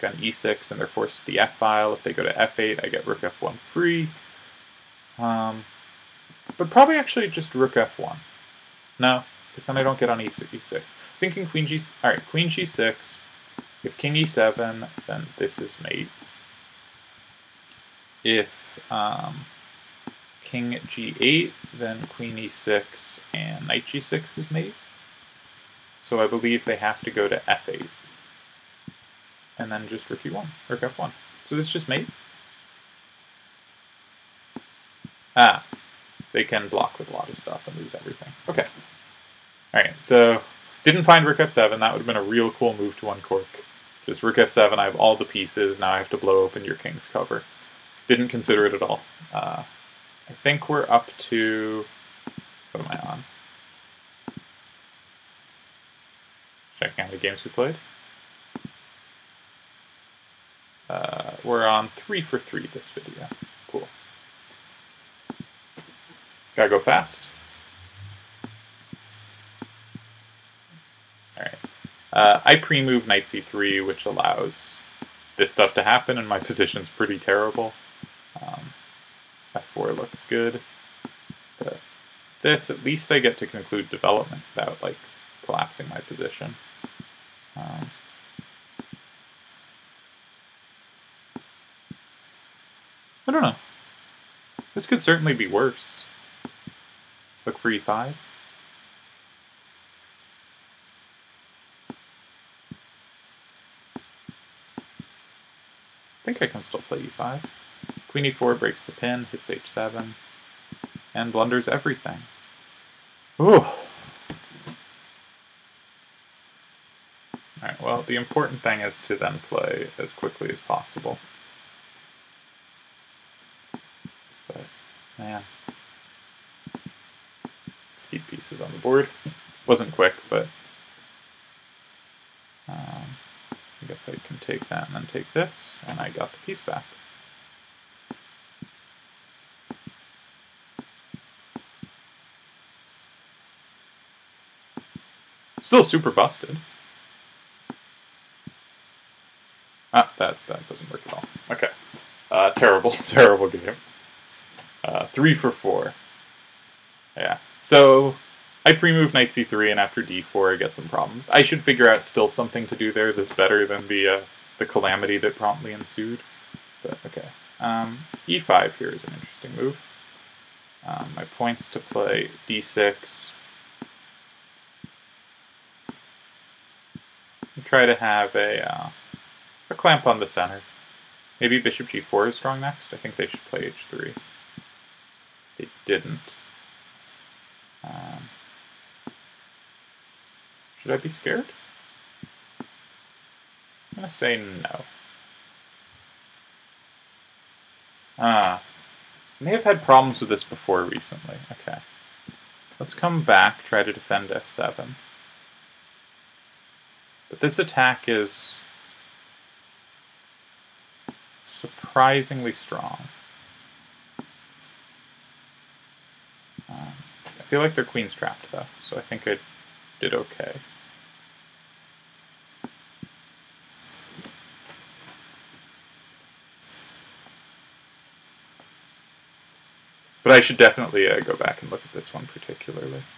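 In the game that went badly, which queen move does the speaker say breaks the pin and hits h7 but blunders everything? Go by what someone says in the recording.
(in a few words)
Queen e4.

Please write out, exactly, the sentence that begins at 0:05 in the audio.
Um, but probably actually just rook f1.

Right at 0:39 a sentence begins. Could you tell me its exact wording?
All right, so didn't find rook f7.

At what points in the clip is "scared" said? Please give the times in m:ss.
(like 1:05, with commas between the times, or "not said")
3:11.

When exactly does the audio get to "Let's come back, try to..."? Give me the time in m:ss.
3:22.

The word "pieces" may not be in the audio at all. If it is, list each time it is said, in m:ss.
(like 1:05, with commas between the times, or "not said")
0:45, 2:08, 2:16.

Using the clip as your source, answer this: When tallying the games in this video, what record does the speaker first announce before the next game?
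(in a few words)
3 for 3.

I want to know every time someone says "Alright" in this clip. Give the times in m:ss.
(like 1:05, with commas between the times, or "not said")
1:11, 1:57.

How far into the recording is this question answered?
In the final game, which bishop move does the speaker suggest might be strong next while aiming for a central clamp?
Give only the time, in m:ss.
3:01.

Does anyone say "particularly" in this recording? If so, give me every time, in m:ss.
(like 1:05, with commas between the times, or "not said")
3:52.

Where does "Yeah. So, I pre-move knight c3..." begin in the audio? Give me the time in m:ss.
2:37.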